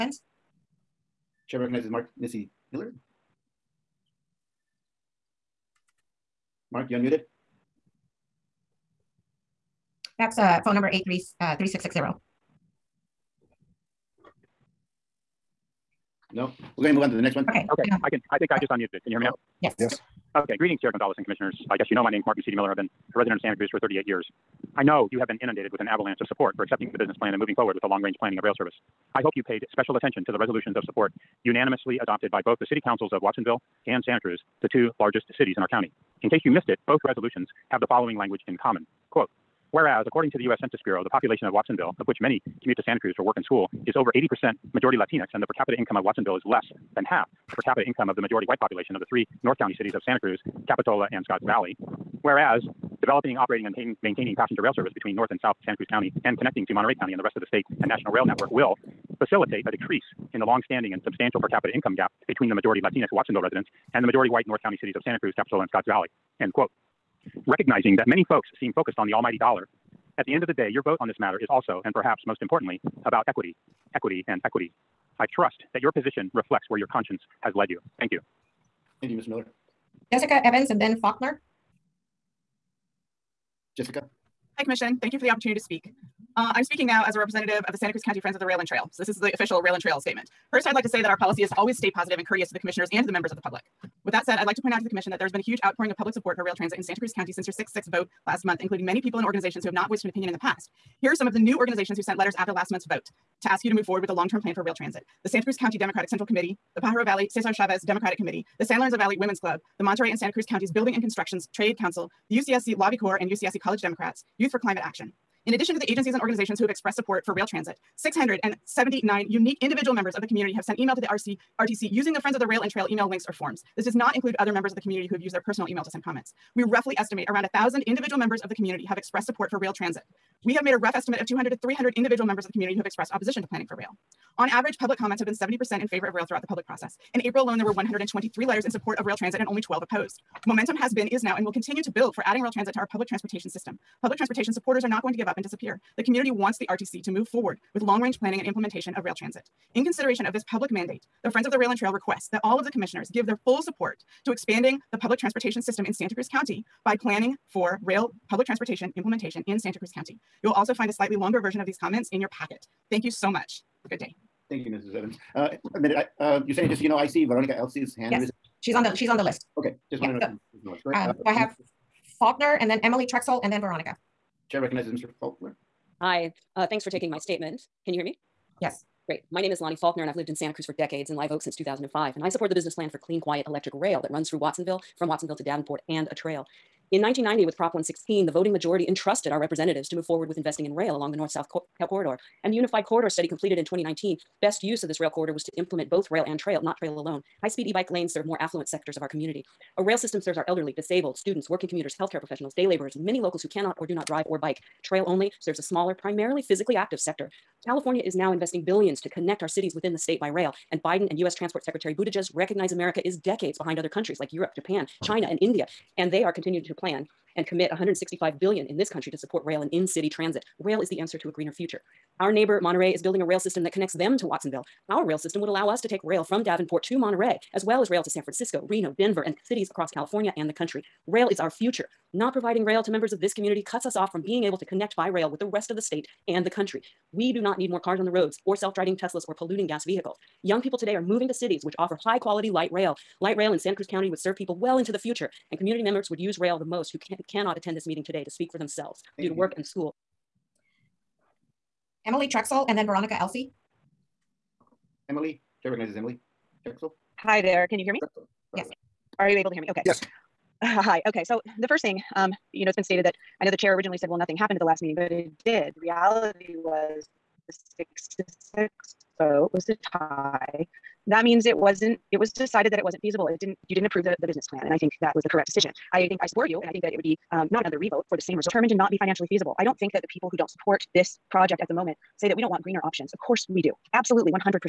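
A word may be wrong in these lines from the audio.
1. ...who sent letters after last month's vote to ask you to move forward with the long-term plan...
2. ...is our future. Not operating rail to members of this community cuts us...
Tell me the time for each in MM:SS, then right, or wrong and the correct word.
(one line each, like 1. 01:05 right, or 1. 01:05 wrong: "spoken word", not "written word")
1. 01:41 right
2. 03:51 wrong: "providing", not "operating".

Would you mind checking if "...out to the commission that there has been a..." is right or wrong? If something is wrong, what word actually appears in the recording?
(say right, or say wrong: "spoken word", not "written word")
right.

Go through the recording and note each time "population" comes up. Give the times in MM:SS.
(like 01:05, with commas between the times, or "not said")
00:41, 00:48.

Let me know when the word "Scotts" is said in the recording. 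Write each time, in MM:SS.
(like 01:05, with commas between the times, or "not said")
00:51, 01:05.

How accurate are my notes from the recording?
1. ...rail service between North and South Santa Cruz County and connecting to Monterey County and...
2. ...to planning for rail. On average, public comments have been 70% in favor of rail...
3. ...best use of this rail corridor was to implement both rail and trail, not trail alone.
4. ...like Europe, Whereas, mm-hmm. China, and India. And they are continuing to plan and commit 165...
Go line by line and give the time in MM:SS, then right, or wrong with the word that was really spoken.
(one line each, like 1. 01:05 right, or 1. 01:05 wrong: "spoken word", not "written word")
1. 00:54 right
2. 02:13 right
3. 03:14 right
4. 03:34 wrong: "Japan", not "Whereas".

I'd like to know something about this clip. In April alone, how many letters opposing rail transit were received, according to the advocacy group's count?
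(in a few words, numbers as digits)
12.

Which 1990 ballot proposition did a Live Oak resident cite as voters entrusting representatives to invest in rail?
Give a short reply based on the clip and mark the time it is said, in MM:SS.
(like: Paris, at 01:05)
Prop 116, at 03:07.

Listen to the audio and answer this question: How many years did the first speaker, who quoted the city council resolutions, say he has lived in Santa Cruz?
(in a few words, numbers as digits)
38.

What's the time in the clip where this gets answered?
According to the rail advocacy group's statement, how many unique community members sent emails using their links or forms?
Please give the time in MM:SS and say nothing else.
01:58.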